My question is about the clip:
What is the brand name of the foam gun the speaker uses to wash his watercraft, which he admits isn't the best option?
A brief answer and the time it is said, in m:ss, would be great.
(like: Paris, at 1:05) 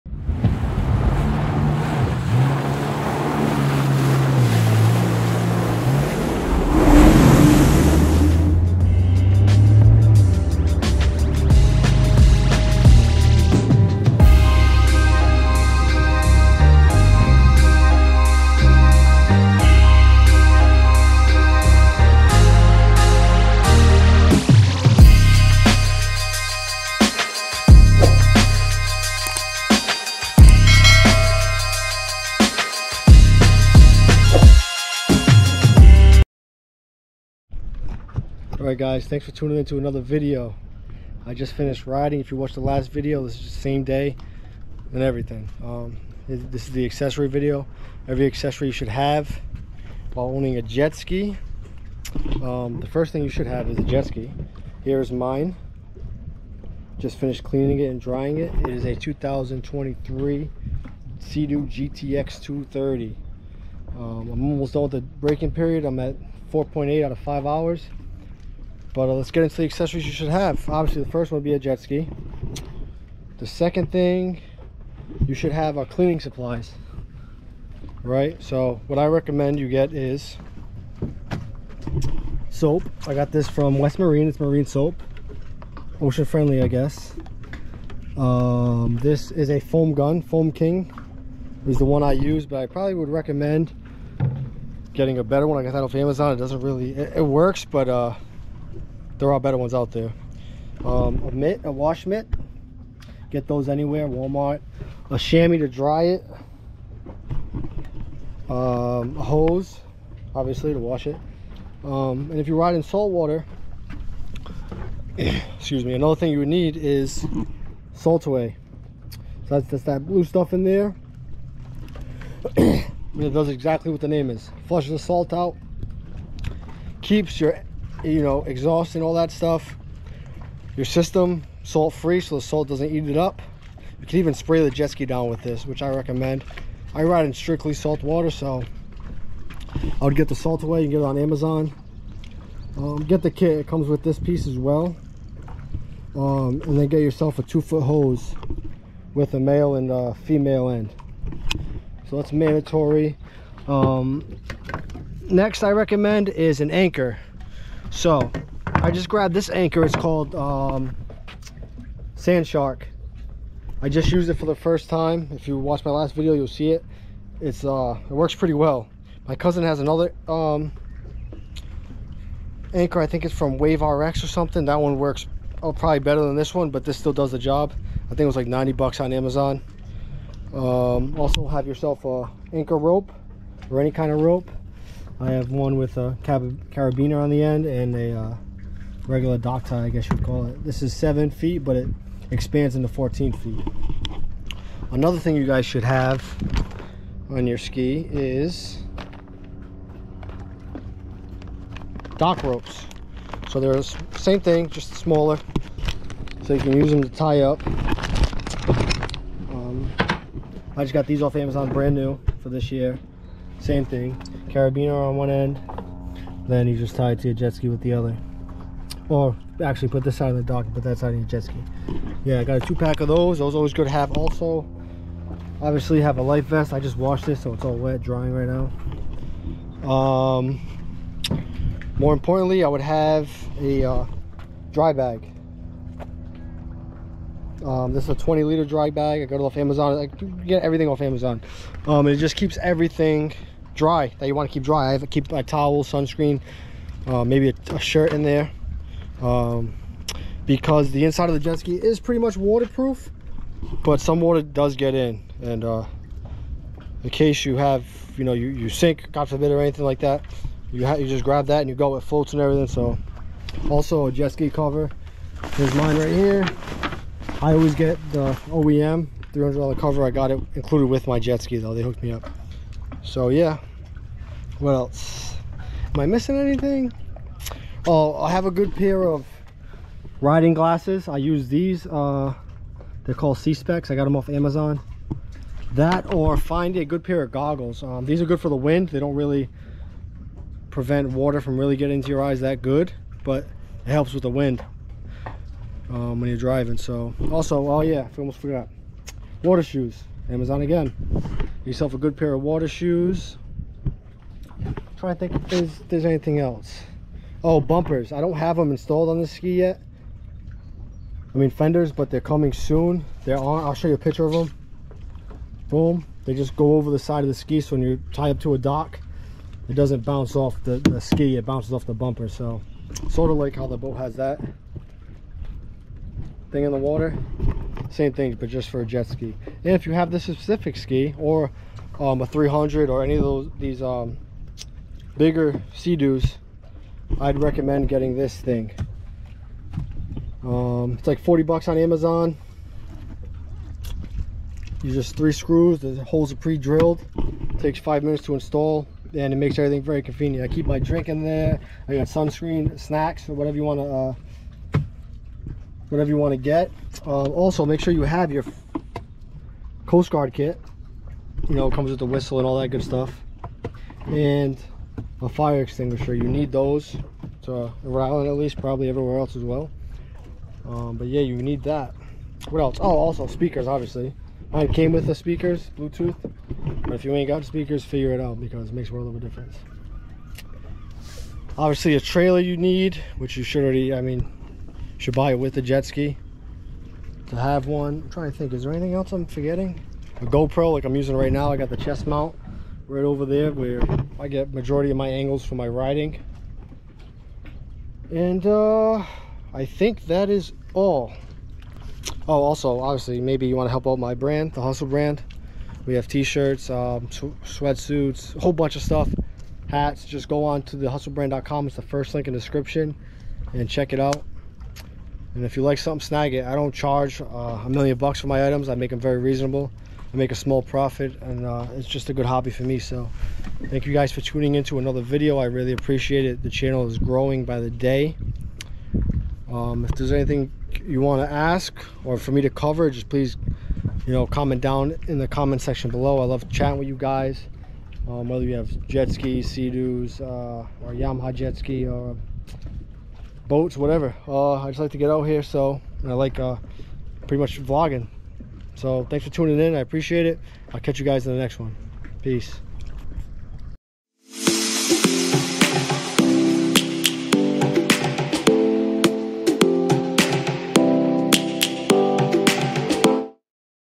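Foam King, at 1:30.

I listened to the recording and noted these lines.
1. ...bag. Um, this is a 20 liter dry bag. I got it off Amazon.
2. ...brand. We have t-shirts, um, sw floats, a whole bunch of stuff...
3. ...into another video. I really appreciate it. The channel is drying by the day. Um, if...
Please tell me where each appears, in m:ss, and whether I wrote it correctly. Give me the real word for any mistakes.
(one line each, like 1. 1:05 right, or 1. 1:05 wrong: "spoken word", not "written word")
1. 3:54 right
2. 6:44 wrong: "sweatsuits", not "floats"
3. 7:04 wrong: "growing", not "drying".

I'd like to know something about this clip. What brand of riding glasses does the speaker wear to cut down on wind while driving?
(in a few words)
SeaSpecs.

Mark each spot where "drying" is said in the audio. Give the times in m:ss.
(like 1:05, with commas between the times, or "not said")
0:57, 3:48.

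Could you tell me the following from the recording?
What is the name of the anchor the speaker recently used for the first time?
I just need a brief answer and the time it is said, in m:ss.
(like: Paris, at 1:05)
Sand Shark, at 2:42.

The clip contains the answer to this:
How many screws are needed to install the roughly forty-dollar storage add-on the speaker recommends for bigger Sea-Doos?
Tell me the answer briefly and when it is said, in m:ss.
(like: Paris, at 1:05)
3, at 5:45.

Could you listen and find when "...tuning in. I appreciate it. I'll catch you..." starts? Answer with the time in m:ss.
7:29.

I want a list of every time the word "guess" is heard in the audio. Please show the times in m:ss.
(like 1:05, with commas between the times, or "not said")
1:26, 3:09.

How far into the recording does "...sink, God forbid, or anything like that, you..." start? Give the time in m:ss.
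4:18.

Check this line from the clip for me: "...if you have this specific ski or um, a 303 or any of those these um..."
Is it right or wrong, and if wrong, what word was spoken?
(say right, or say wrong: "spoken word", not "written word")
wrong: "300", not "303".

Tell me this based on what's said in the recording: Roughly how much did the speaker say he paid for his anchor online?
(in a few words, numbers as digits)
$90.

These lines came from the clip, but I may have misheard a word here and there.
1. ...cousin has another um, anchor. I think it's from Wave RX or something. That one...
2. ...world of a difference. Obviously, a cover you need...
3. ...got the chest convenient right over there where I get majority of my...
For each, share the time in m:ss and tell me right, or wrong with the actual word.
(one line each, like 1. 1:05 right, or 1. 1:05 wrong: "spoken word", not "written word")
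1. 2:49 right
2. 6:18 wrong: "trailer", not "cover"
3. 6:31 wrong: "mount", not "convenient".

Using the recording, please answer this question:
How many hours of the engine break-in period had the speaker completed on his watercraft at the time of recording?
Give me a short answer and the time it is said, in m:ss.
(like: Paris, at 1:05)
4.8, at 1:06.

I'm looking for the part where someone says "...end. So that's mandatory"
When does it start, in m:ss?
2:30.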